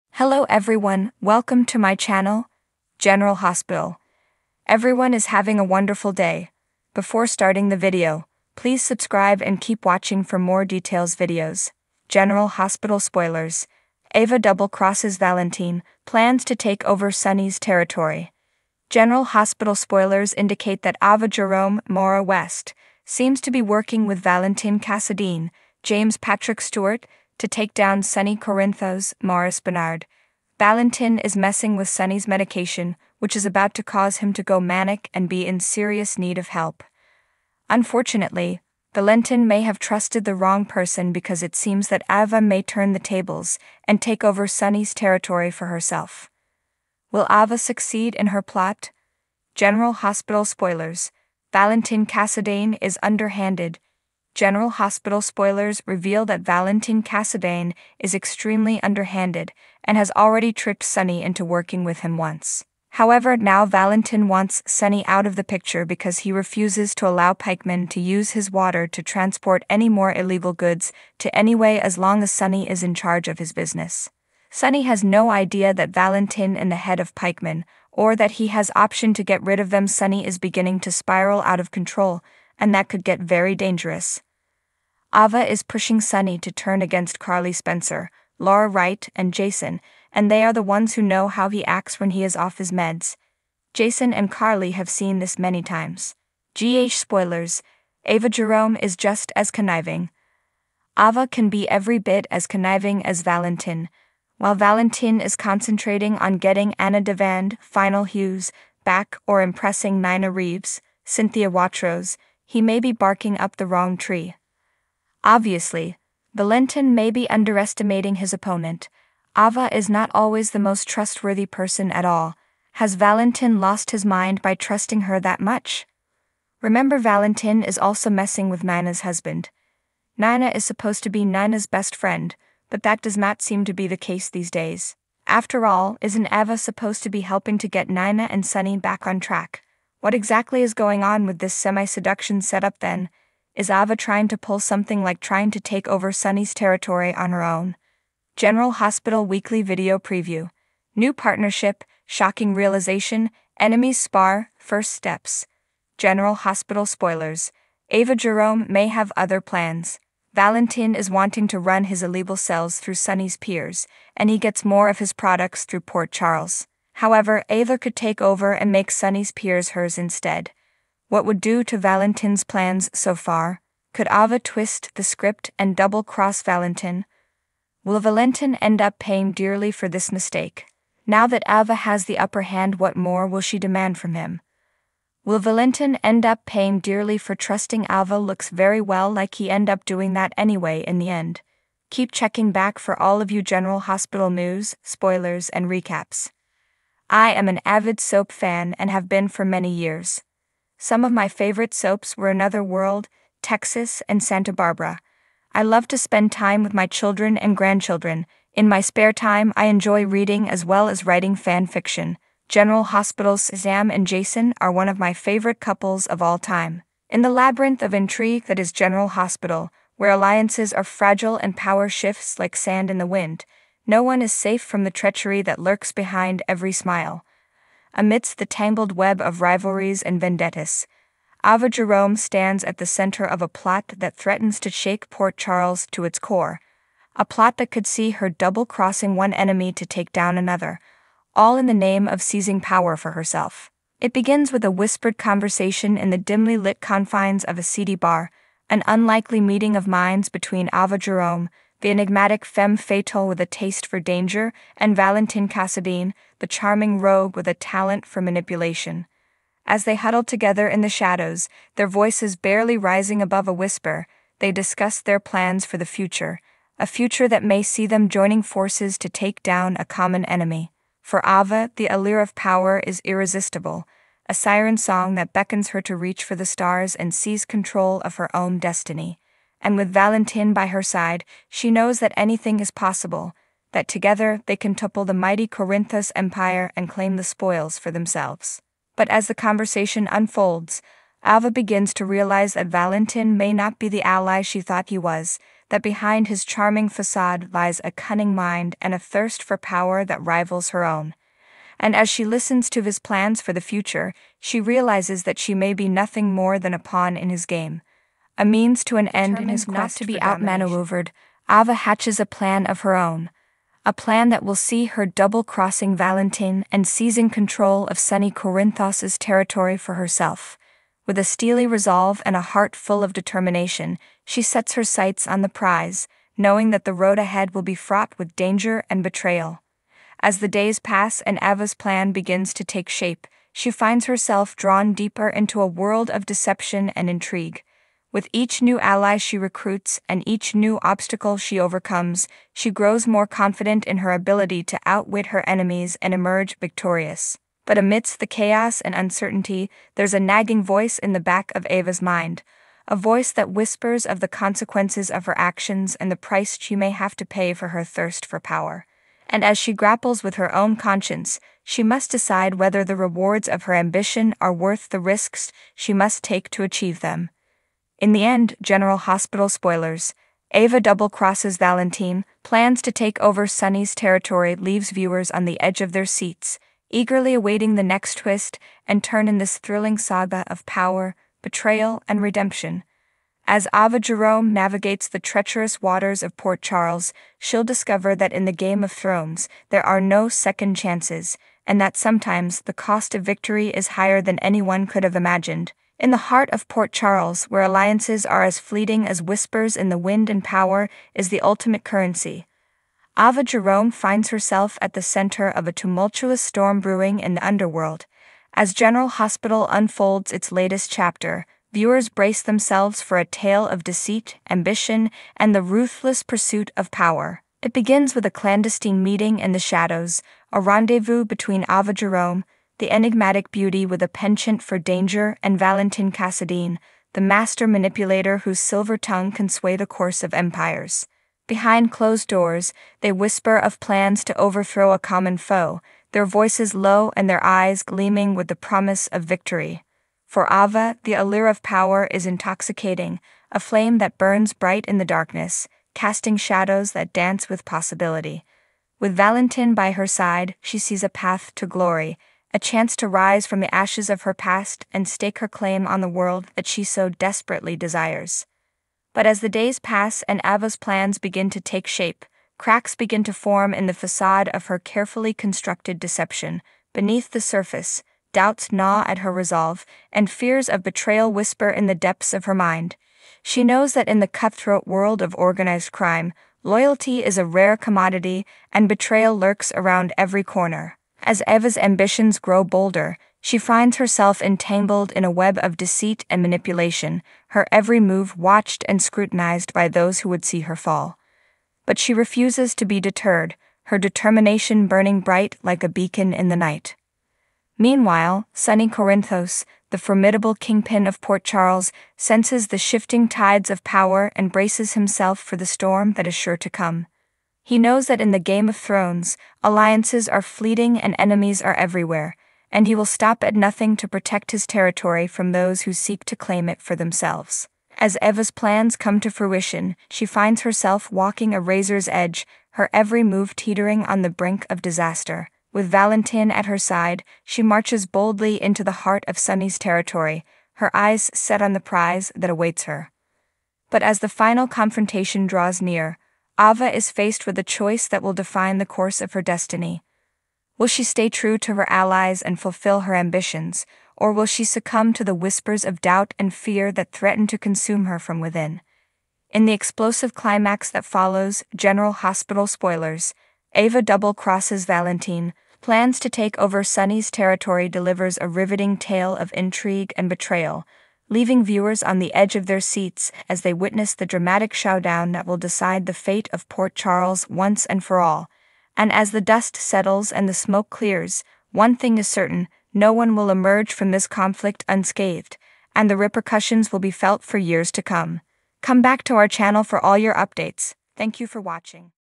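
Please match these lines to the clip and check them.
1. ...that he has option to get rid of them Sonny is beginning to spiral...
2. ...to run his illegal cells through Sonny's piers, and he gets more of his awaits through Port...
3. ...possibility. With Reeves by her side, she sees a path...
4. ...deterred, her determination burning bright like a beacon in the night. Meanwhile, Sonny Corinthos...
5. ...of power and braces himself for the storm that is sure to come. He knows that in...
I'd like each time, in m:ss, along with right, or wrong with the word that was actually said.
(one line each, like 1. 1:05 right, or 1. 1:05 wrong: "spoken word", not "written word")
1. 1:18 right
2. 2:41 wrong: "products", not "awaits"
3. 7:27 wrong: "Valentin", not "Reeves"
4. 8:12 right
5. 8:23 right.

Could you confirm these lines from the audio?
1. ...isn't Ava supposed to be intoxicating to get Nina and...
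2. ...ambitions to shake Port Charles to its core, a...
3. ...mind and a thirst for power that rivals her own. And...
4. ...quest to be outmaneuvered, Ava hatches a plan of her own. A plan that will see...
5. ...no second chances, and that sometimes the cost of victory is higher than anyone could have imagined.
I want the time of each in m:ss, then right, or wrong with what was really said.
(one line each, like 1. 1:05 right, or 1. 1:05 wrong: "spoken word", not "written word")
1. 2:16 wrong: "helping", not "intoxicating"
2. 3:54 wrong: "threatens", not "ambitions"
3. 4:58 right
4. 5:09 right
5. 6:30 right.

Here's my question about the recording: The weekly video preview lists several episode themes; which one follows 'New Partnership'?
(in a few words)
Shocking Realization.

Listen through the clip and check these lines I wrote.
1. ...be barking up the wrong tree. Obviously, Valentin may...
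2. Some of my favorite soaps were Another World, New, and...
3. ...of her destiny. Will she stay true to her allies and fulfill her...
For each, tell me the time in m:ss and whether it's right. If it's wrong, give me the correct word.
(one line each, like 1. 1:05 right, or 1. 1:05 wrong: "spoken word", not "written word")
1. 1:52 right
2. 3:20 wrong: "Texas", not "New"
3. 8:59 right.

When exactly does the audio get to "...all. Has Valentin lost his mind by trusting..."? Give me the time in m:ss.
2:02.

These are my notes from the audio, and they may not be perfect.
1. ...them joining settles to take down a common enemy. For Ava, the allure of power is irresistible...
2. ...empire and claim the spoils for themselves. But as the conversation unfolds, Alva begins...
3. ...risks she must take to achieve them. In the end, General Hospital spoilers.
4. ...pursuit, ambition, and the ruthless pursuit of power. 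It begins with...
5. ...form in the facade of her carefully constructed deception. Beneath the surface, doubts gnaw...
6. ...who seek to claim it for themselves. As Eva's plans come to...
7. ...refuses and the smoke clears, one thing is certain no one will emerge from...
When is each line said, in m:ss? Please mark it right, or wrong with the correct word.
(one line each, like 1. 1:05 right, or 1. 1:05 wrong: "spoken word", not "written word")
1. 4:27 wrong: "forces", not "settles"
2. 4:46 right
3. 6:04 right
4. 6:53 wrong: "deceit", not "pursuit"
5. 7:43 right
6. 8:35 right
7. 9:29 wrong: "settles", not "refuses".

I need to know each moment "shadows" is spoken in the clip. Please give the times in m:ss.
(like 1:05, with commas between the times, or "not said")
4:20, 6:59, 7:26.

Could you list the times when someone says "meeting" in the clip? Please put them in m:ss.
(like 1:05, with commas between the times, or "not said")
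4:09, 6:59.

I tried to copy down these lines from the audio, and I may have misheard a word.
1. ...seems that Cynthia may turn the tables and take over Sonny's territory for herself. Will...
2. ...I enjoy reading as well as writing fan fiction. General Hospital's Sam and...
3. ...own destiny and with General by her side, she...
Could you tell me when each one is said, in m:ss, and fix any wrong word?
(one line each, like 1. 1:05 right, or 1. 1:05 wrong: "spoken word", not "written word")
1. 0:41 wrong: "Ava", not "Cynthia"
2. 3:29 right
3. 4:38 wrong: "Valentin", not "General".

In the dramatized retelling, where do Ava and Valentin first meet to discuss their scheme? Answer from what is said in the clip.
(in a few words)
a seedy bar.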